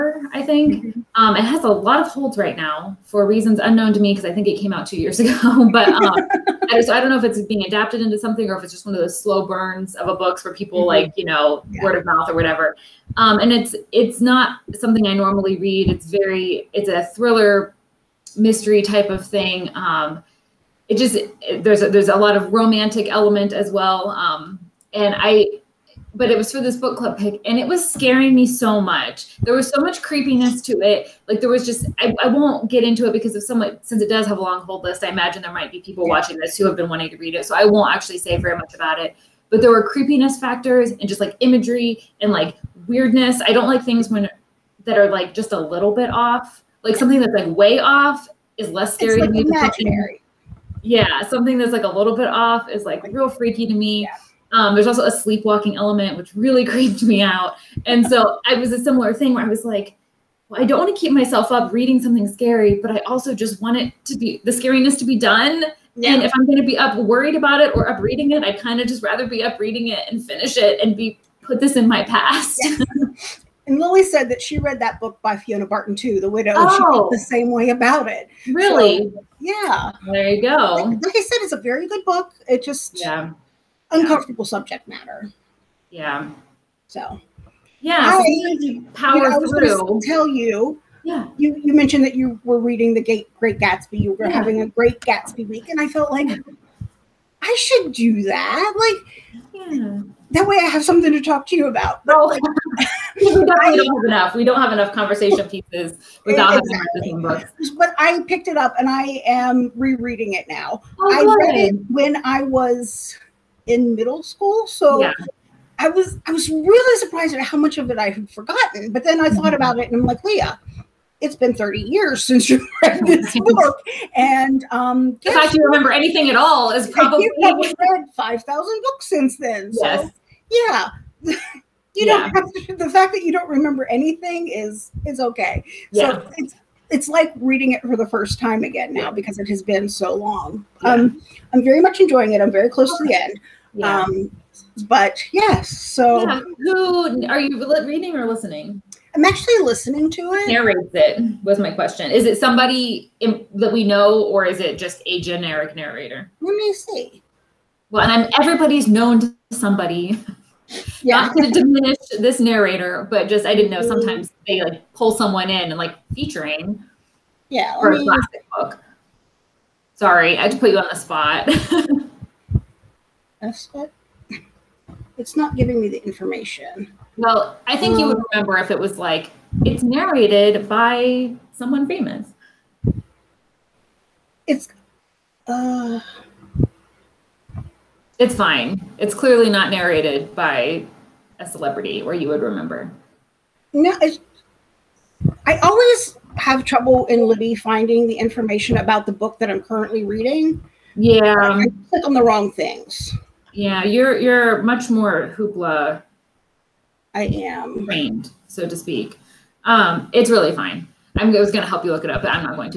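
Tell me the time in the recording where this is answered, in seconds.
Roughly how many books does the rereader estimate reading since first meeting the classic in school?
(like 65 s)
128 s.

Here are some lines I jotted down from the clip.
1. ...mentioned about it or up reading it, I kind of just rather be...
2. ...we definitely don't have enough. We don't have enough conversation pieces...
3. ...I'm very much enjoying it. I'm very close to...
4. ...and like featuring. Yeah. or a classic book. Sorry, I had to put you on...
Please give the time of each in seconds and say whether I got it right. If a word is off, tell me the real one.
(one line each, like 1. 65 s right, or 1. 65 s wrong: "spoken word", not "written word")
1. 66 s wrong: "worried", not "mentioned"
2. 103 s right
3. 141 s right
4. 165 s right.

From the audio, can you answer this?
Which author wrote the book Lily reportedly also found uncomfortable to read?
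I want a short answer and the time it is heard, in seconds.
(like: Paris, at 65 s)
Fiona Barton, at 75 s.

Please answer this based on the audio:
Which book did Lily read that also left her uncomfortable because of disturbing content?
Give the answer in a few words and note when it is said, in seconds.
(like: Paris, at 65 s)
The Widow, at 76 s.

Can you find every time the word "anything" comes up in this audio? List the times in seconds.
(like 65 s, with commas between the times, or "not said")
125 s, 133 s.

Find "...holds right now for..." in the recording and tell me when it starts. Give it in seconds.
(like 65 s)
2 s.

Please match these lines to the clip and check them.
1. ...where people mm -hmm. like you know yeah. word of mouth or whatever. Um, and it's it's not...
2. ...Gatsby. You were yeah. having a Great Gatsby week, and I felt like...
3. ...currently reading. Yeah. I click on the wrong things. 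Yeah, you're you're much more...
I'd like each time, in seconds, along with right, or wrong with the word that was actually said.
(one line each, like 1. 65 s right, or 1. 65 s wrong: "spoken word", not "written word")
1. 10 s right
2. 93 s right
3. 199 s right.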